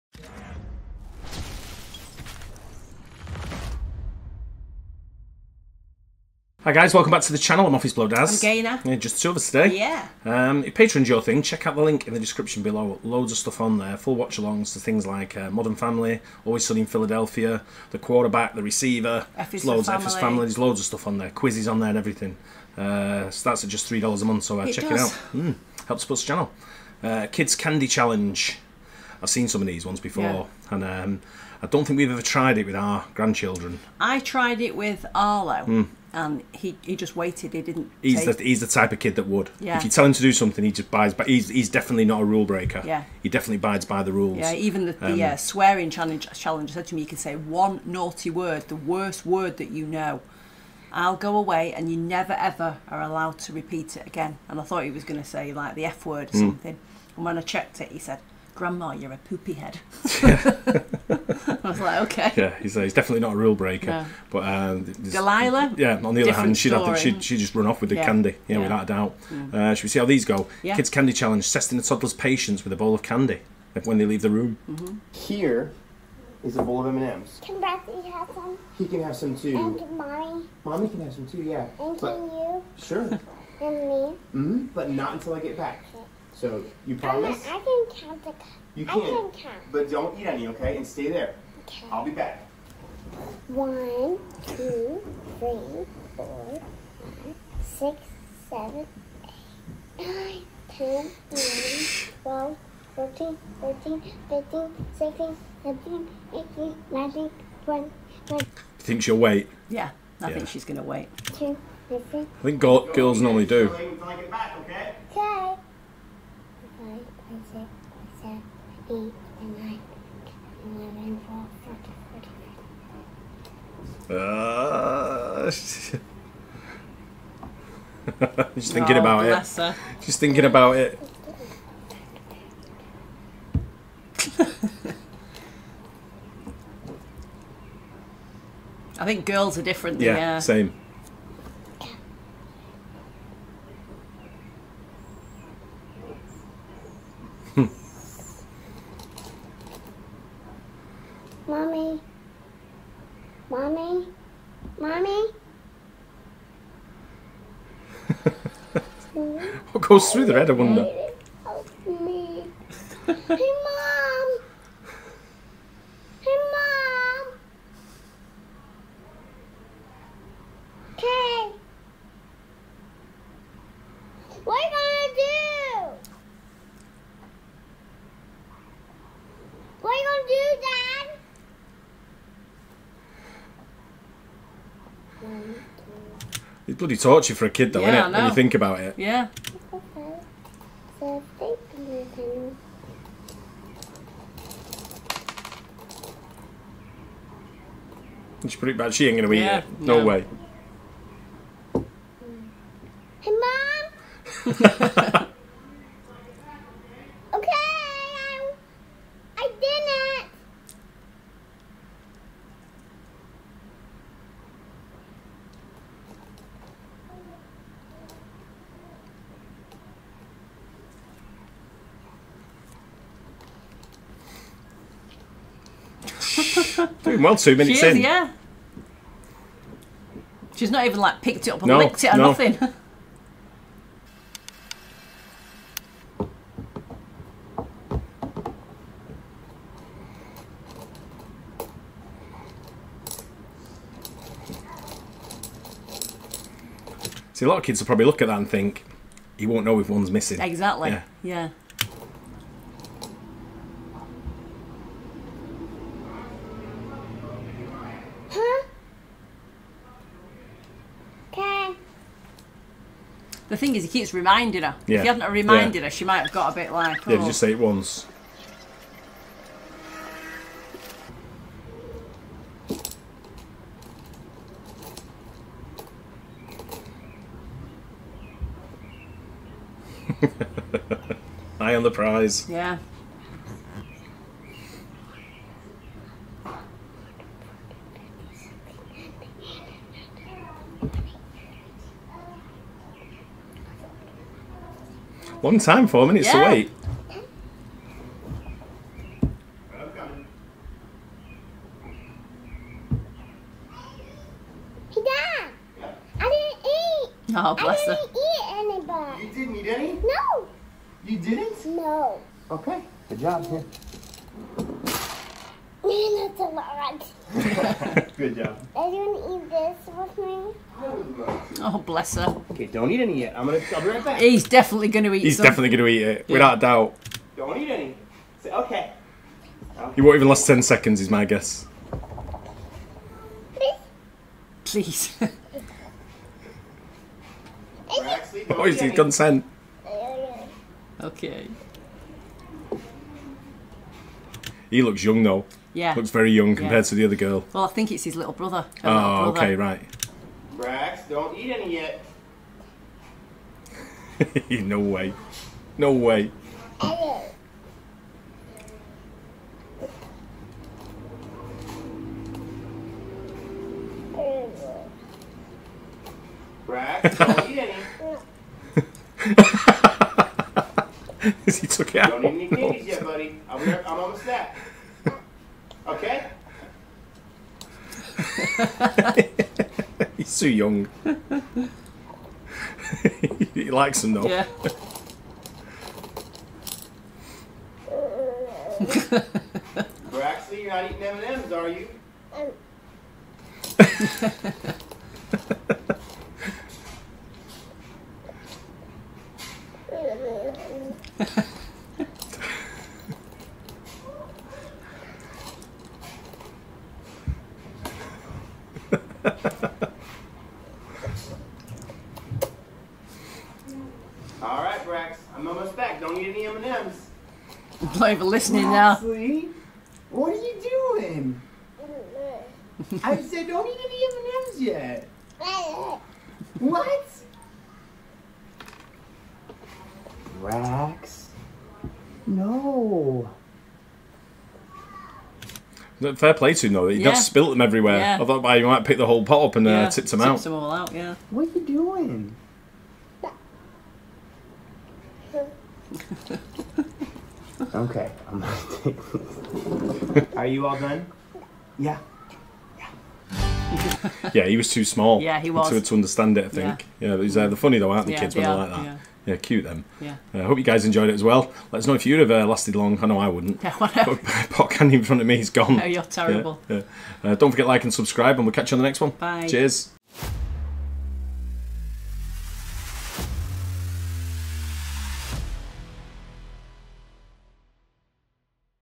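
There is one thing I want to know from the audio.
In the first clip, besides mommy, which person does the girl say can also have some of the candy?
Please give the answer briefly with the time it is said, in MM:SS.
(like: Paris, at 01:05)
Bradley, at 01:17.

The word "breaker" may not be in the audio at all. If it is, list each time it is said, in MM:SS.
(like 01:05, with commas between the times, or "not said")
00:42, 01:03.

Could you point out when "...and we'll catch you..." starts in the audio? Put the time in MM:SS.
07:48.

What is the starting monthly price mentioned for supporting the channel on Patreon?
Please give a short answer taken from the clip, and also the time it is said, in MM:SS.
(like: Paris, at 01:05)
3 dollars, at 00:23.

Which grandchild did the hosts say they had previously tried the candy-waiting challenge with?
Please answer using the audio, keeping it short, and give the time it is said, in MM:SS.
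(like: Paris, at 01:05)
Arlo, at 00:35.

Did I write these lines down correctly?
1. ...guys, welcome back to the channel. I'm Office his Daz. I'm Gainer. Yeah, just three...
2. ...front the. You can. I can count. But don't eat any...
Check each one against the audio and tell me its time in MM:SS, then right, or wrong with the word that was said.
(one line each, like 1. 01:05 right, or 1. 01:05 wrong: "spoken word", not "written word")
1. 00:06 wrong: "two", not "three"
2. 01:28 wrong: "count", not "front".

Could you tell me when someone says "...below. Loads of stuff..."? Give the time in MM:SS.
00:12.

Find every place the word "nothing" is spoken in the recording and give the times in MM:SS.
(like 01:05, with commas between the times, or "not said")
03:52.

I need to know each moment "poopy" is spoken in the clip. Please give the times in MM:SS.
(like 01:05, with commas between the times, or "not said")
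00:59.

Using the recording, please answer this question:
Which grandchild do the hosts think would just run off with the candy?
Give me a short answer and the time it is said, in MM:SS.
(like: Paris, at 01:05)
Delilah, at 01:04.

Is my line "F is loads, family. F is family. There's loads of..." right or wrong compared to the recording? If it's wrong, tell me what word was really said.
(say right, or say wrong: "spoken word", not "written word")
right.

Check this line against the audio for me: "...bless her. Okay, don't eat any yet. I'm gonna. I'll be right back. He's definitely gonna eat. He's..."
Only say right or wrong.
right.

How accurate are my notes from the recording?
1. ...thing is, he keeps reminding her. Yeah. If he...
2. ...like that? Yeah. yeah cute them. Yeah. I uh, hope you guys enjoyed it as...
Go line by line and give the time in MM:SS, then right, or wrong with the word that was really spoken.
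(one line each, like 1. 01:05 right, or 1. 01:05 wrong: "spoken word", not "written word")
1. 04:23 right
2. 07:38 right.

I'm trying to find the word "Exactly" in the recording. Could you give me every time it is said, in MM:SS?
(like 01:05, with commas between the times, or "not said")
04:10.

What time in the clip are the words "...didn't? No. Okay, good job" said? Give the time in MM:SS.
05:11.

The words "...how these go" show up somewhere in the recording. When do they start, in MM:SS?
01:09.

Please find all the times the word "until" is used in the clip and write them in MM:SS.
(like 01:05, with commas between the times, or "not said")
01:25.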